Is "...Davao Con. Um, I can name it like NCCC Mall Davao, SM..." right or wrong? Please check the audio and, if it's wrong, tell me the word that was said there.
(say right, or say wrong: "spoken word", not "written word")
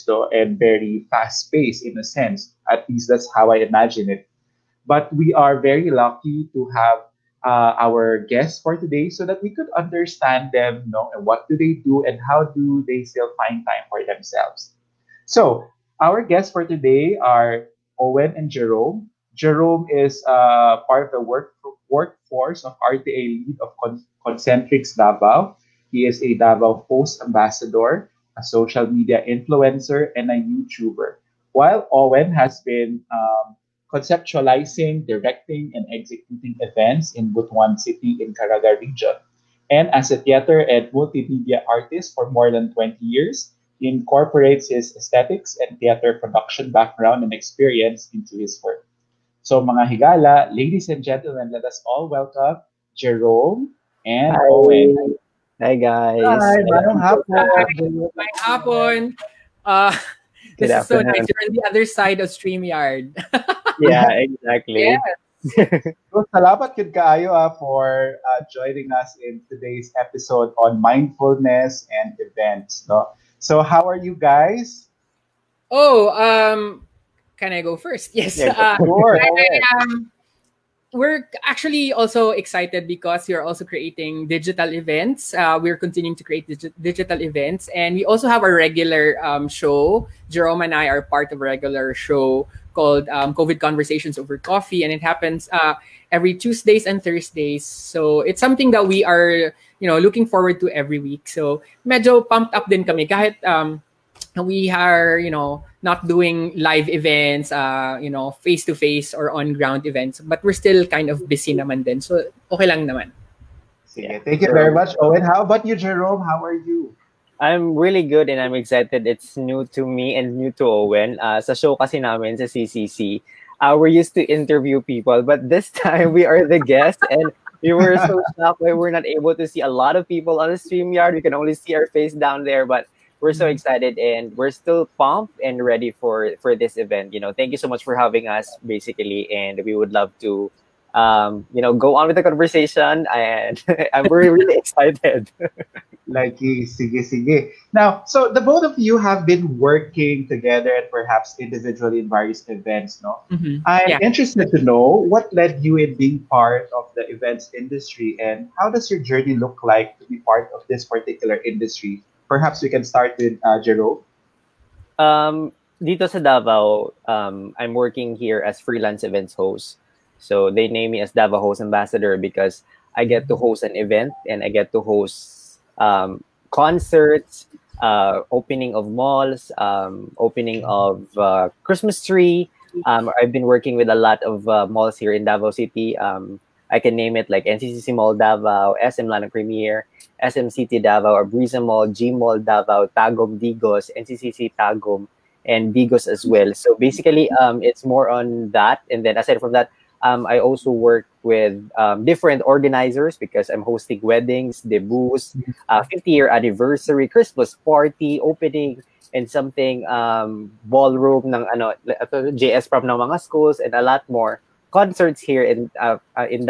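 wrong: "City", not "Con".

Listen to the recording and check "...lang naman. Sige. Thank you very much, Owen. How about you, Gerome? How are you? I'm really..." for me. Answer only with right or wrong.
right.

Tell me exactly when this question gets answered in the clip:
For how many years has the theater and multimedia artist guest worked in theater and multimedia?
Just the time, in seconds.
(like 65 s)
42 s.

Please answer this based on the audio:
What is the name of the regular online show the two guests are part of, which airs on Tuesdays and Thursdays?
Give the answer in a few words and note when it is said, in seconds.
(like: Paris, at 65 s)
COVID Conversations Over Coffee, at 93 s.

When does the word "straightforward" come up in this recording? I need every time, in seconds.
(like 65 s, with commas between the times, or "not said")
not said.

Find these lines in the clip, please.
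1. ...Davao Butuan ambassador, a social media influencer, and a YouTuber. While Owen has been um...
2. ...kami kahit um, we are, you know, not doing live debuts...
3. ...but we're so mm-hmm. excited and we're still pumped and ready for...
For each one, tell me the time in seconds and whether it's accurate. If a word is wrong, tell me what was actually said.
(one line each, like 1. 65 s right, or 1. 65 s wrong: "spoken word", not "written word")
1. 26 s wrong: "Host", not "Butuan"
2. 102 s wrong: "events", not "debuts"
3. 132 s right.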